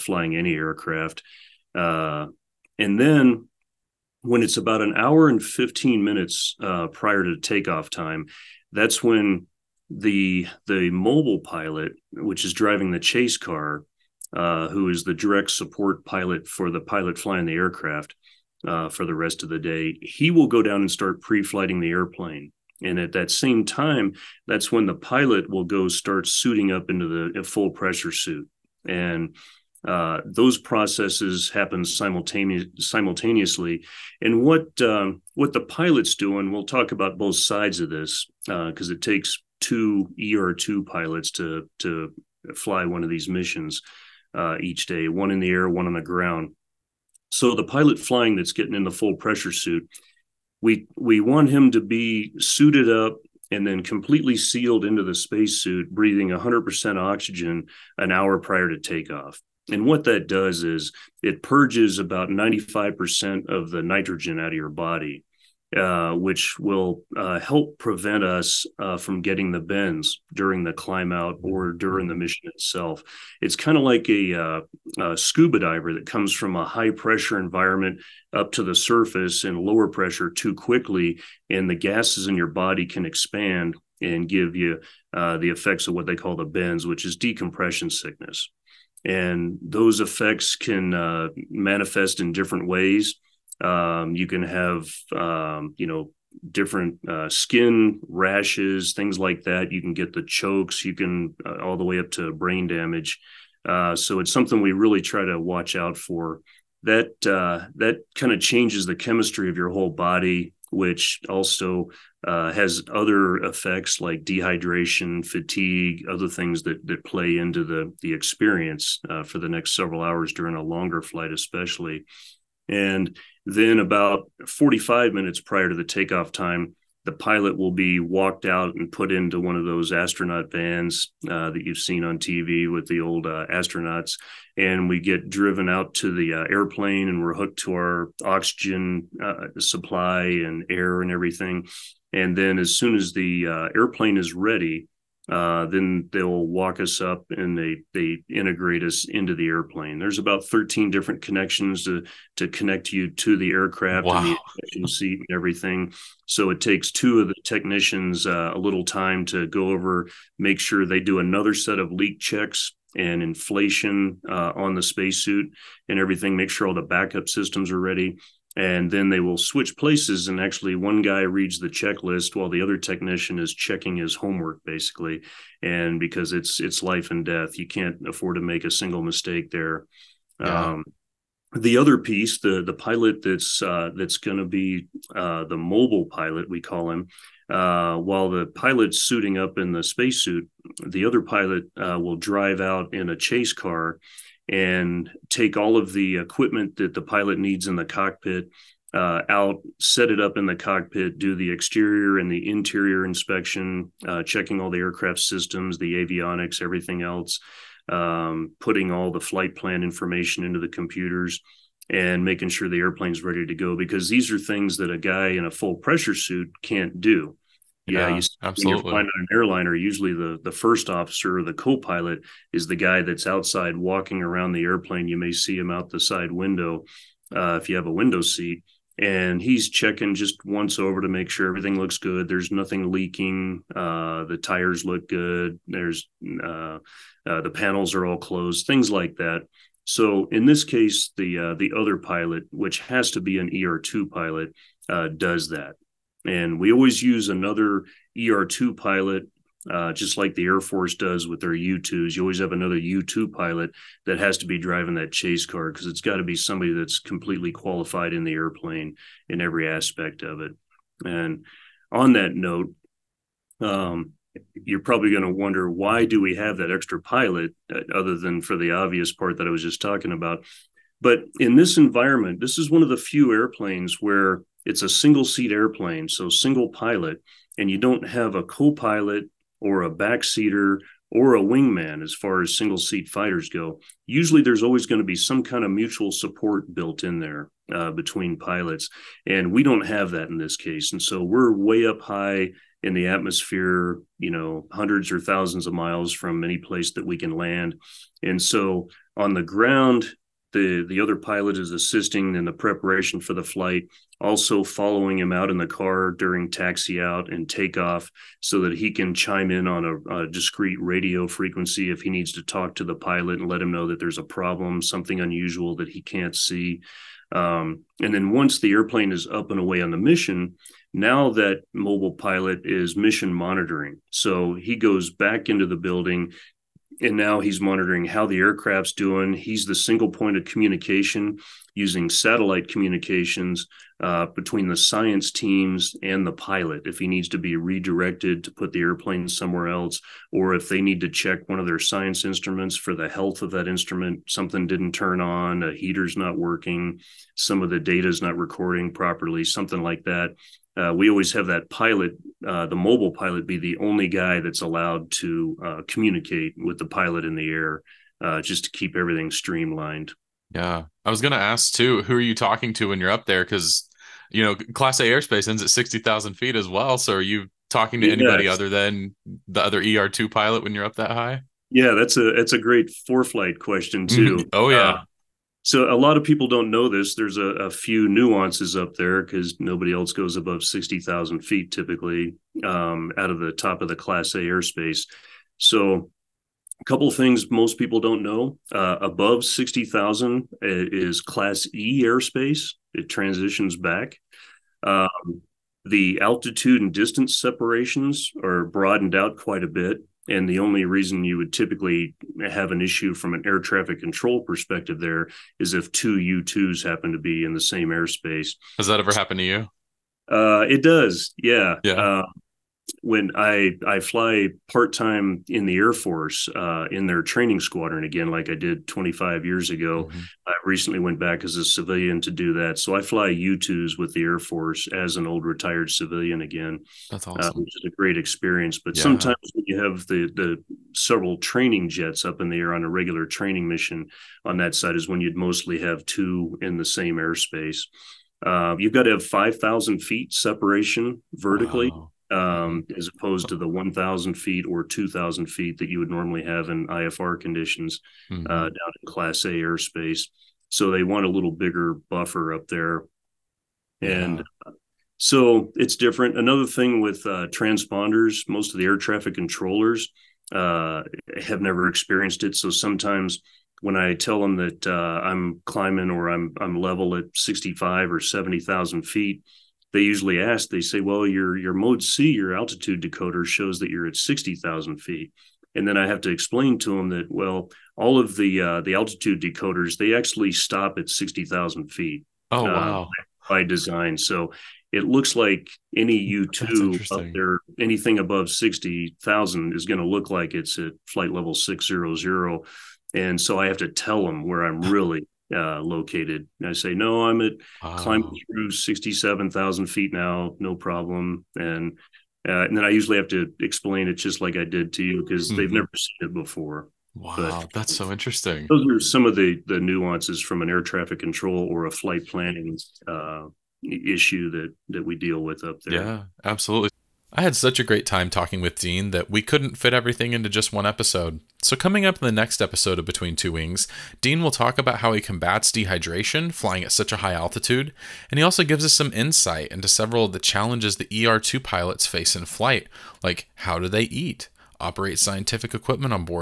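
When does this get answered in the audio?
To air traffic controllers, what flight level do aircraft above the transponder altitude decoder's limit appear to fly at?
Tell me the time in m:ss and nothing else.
8:11.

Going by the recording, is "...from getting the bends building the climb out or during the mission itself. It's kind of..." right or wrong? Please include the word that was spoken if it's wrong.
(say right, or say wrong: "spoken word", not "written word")
wrong: "during", not "building".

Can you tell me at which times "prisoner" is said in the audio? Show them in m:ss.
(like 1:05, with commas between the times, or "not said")
not said.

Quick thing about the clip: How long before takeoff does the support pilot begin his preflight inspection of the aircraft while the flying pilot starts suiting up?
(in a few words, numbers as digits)
1 hour 15 minutes.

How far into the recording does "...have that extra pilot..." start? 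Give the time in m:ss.
4:26.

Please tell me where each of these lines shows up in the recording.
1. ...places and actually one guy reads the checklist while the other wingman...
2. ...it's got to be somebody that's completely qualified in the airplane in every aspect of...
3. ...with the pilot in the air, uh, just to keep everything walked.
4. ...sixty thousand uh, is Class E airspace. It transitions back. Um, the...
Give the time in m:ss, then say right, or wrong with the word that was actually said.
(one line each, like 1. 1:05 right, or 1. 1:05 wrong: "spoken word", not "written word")
1. 2:49 wrong: "technician", not "wingman"
2. 4:15 right
3. 5:56 wrong: "streamlined", not "walked"
4. 6:29 right.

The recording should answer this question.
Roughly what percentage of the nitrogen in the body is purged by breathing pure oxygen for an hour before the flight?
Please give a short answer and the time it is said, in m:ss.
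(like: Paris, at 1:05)
95%, at 1:02.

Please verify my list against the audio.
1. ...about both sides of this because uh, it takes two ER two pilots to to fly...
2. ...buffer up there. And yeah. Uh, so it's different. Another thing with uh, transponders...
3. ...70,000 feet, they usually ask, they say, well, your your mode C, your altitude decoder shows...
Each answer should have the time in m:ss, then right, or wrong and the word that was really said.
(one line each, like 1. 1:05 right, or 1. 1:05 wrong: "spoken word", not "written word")
1. 0:36 right
2. 7:32 right
3. 7:48 right.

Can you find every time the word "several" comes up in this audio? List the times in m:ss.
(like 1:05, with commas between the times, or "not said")
1:59, 7:10, 8:49.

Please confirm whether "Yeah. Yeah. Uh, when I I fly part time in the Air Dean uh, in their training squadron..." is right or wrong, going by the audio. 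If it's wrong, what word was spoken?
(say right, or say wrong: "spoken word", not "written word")
wrong: "Force", not "Dean".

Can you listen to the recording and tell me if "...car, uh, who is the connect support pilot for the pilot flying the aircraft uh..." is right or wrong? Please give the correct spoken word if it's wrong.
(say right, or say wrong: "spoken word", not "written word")
wrong: "direct", not "connect".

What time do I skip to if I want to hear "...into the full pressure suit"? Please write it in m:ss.
0:26.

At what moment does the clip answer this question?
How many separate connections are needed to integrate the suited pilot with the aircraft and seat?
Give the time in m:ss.
2:30.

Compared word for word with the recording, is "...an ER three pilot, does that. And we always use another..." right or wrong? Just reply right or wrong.
wrong.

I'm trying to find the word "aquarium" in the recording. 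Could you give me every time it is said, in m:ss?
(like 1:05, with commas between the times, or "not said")
not said.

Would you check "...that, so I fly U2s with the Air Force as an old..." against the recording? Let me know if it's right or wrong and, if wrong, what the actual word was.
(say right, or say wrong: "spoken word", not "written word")
right.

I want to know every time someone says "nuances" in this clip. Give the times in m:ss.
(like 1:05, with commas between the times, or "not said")
6:18, 8:29.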